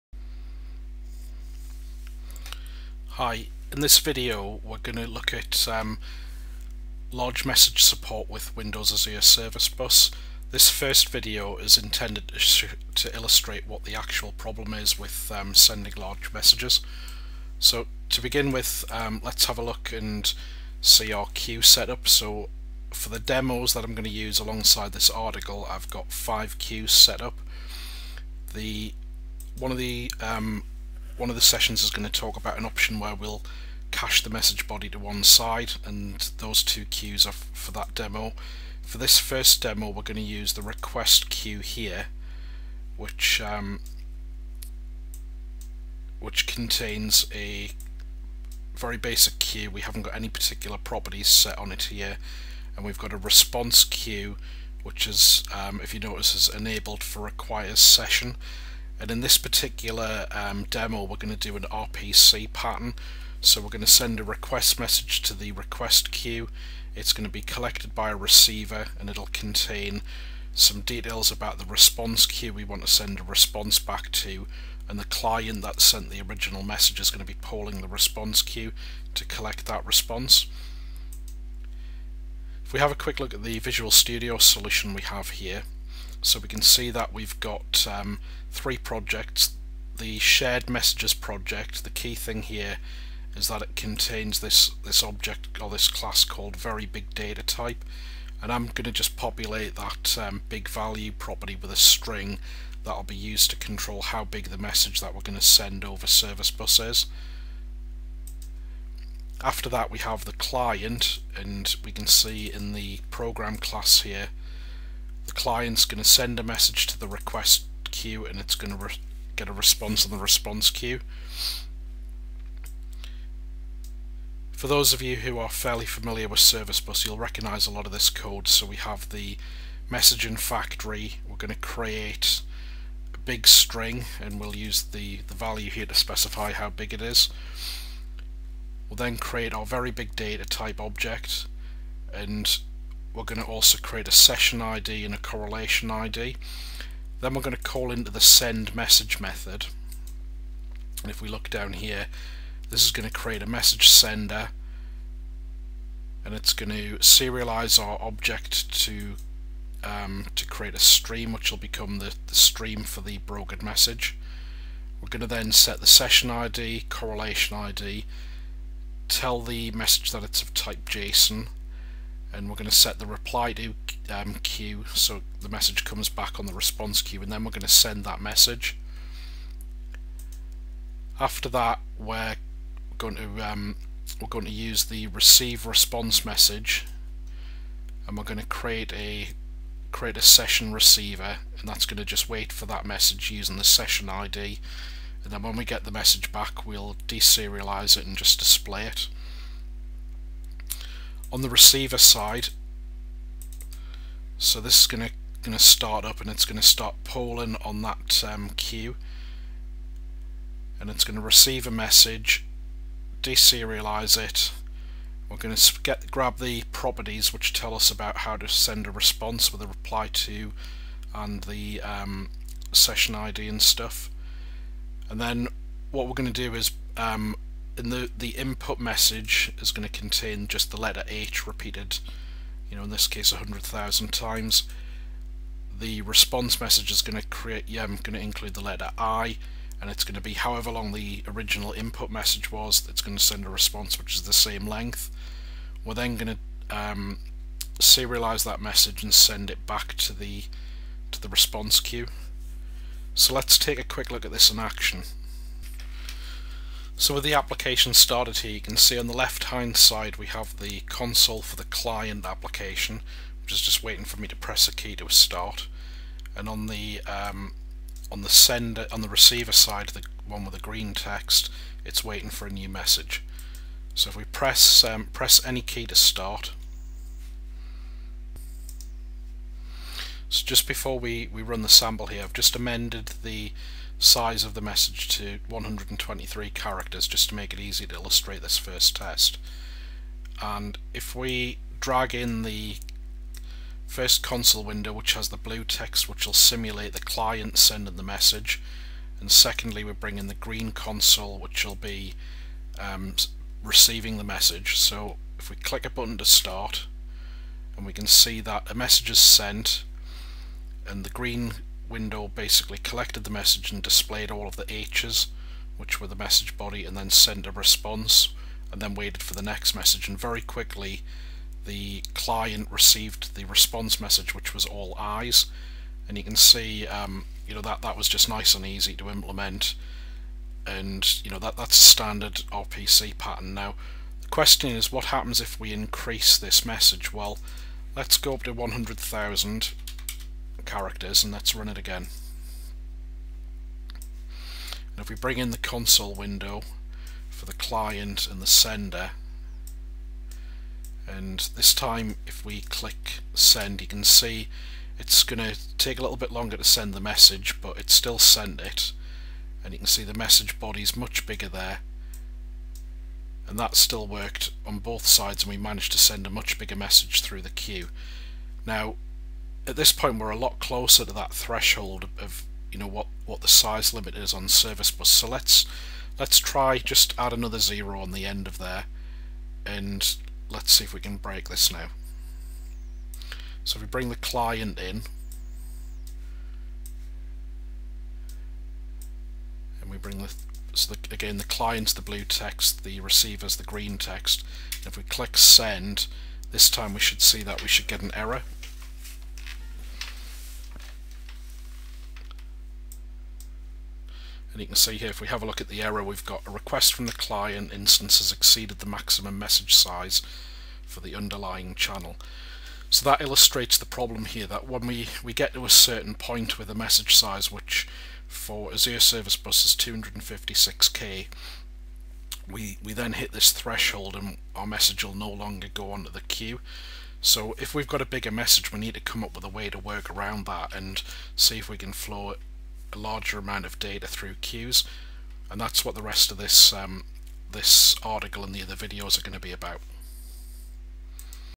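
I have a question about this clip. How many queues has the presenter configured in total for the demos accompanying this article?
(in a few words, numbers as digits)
5.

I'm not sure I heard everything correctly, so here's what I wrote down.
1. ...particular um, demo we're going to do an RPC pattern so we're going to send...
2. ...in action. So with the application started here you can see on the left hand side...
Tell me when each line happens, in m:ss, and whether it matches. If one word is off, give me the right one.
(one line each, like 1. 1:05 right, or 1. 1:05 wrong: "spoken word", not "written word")
1. 0:59 right
2. 4:14 right.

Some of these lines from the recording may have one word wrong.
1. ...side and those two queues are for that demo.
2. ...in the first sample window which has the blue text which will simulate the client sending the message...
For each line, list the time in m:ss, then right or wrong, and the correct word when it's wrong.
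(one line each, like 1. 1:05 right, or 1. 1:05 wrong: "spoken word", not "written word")
1. 0:35 right
2. 4:52 wrong: "console", not "sample".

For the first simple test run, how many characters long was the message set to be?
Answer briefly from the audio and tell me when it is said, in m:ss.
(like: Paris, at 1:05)
123, at 4:45.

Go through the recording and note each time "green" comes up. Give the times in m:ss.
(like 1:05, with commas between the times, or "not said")
4:30, 5:00, 5:11, 6:33.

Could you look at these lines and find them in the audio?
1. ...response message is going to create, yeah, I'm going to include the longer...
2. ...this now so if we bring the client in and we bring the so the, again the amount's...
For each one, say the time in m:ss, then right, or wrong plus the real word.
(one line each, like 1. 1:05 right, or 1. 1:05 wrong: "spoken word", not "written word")
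1. 3:56 wrong: "letter", not "longer"
2. 6:21 wrong: "client", not "amount".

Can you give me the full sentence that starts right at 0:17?
So to begin with, um, let's have a look and see our queue setup.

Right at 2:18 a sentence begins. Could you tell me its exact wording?
We'll then create our very big data type object and we're going to also create a session ID and a correlation ID.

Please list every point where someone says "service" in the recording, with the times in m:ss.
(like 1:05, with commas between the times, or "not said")
0:09, 1:46, 2:06, 6:14, 6:58.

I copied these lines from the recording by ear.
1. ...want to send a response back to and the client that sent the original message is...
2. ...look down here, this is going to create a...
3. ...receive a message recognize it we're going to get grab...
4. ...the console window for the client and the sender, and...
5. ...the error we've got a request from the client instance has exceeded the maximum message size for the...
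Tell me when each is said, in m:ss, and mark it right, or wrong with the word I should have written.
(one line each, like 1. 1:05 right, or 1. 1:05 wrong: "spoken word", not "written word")
1. 1:12 right
2. 2:31 right
3. 3:31 wrong: "deserialize", not "recognize"
4. 5:45 right
5. 6:45 right.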